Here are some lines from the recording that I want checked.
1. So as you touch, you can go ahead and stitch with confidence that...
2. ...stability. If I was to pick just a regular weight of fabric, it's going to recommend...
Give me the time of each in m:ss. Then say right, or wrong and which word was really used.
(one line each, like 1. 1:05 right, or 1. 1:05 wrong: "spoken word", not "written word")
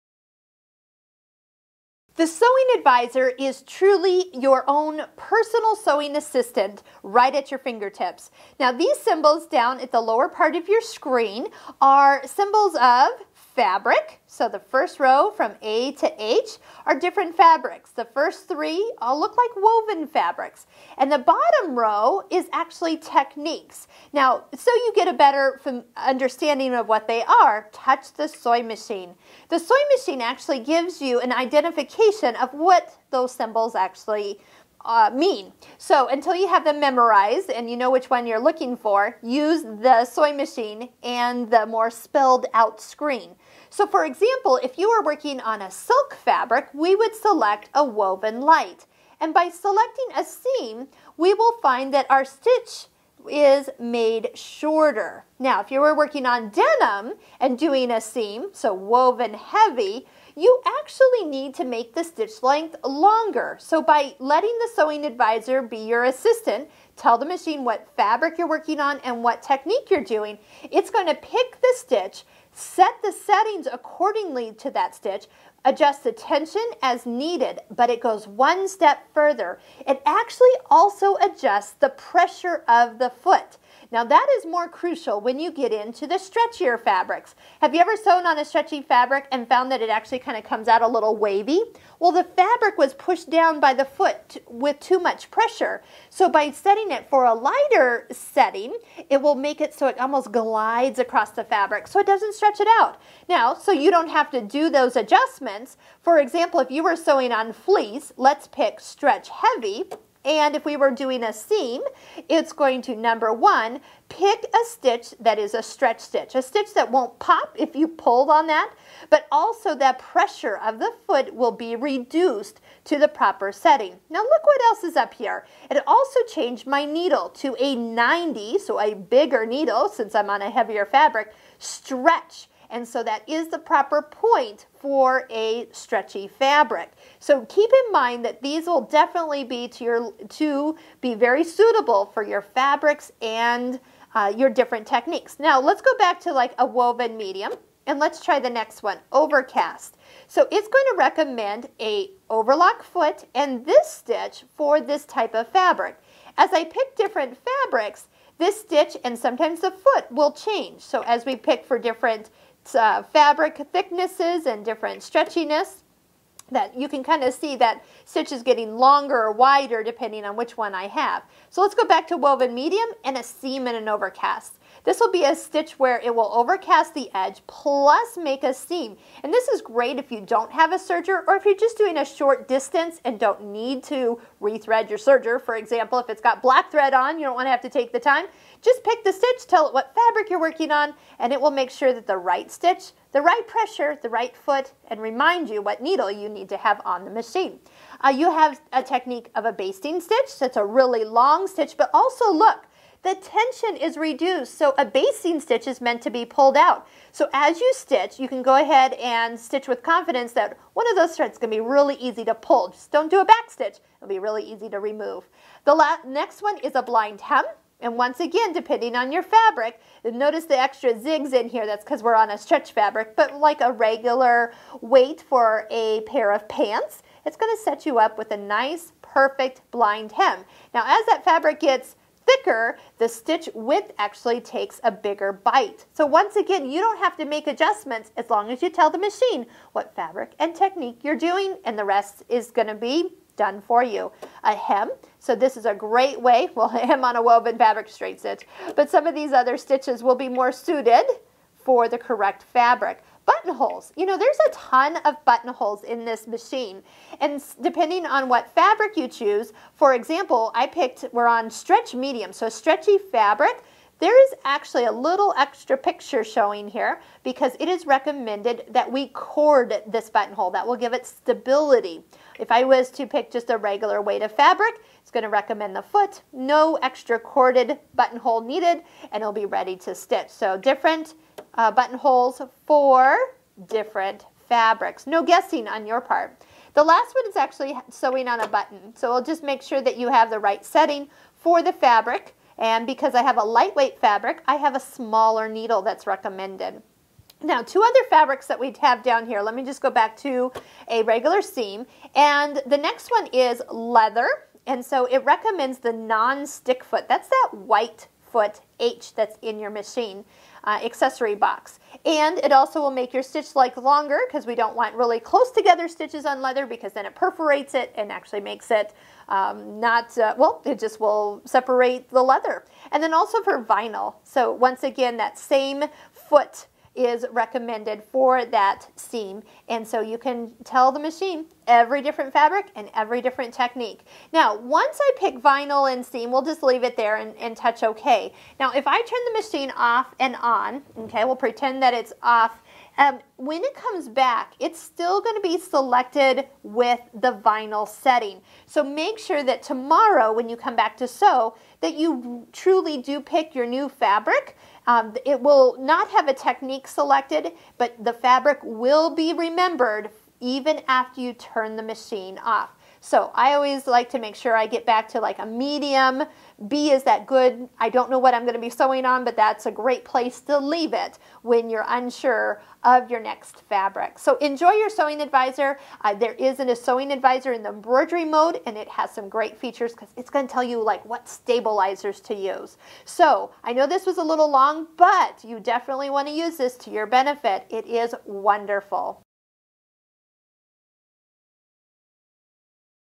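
1. 3:27 wrong: "stitch", not "touch"
2. 4:31 right.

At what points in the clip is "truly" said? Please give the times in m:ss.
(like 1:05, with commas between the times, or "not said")
0:03, 5:52.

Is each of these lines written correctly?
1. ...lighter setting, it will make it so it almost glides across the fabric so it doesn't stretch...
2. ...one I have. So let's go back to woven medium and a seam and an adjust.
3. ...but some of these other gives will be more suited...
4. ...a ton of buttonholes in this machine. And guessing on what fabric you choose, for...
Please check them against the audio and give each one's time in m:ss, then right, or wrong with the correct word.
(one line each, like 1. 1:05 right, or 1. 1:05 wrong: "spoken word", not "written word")
1. 1:37 right
2. 2:50 wrong: "overcast", not "adjust"
3. 4:08 wrong: "stitches", not "gives"
4. 4:14 wrong: "depending", not "guessing".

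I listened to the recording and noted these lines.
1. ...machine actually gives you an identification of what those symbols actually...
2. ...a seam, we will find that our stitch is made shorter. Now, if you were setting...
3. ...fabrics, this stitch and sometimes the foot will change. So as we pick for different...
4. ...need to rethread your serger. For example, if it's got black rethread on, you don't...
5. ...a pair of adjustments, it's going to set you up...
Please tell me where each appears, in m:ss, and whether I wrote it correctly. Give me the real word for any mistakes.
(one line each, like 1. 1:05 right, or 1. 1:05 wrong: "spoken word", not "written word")
1. 0:29 right
2. 0:50 wrong: "working", not "setting"
3. 2:37 right
4. 3:03 wrong: "thread", not "rethread"
5. 3:45 wrong: "pants", not "adjustments".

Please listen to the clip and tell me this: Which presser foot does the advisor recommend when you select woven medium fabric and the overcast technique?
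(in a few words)
overlock foot.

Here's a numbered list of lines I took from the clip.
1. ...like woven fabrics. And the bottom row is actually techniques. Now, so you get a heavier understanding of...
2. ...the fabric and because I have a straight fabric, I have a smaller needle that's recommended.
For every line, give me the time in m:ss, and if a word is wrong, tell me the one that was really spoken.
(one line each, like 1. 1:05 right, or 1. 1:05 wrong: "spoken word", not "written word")
1. 0:19 wrong: "better", not "heavier"
2. 4:51 wrong: "lightweight", not "straight".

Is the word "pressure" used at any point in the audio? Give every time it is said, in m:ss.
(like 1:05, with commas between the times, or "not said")
1:21, 1:35, 1:59, 3:13.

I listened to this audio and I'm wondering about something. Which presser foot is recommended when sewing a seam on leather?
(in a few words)
non-stick foot.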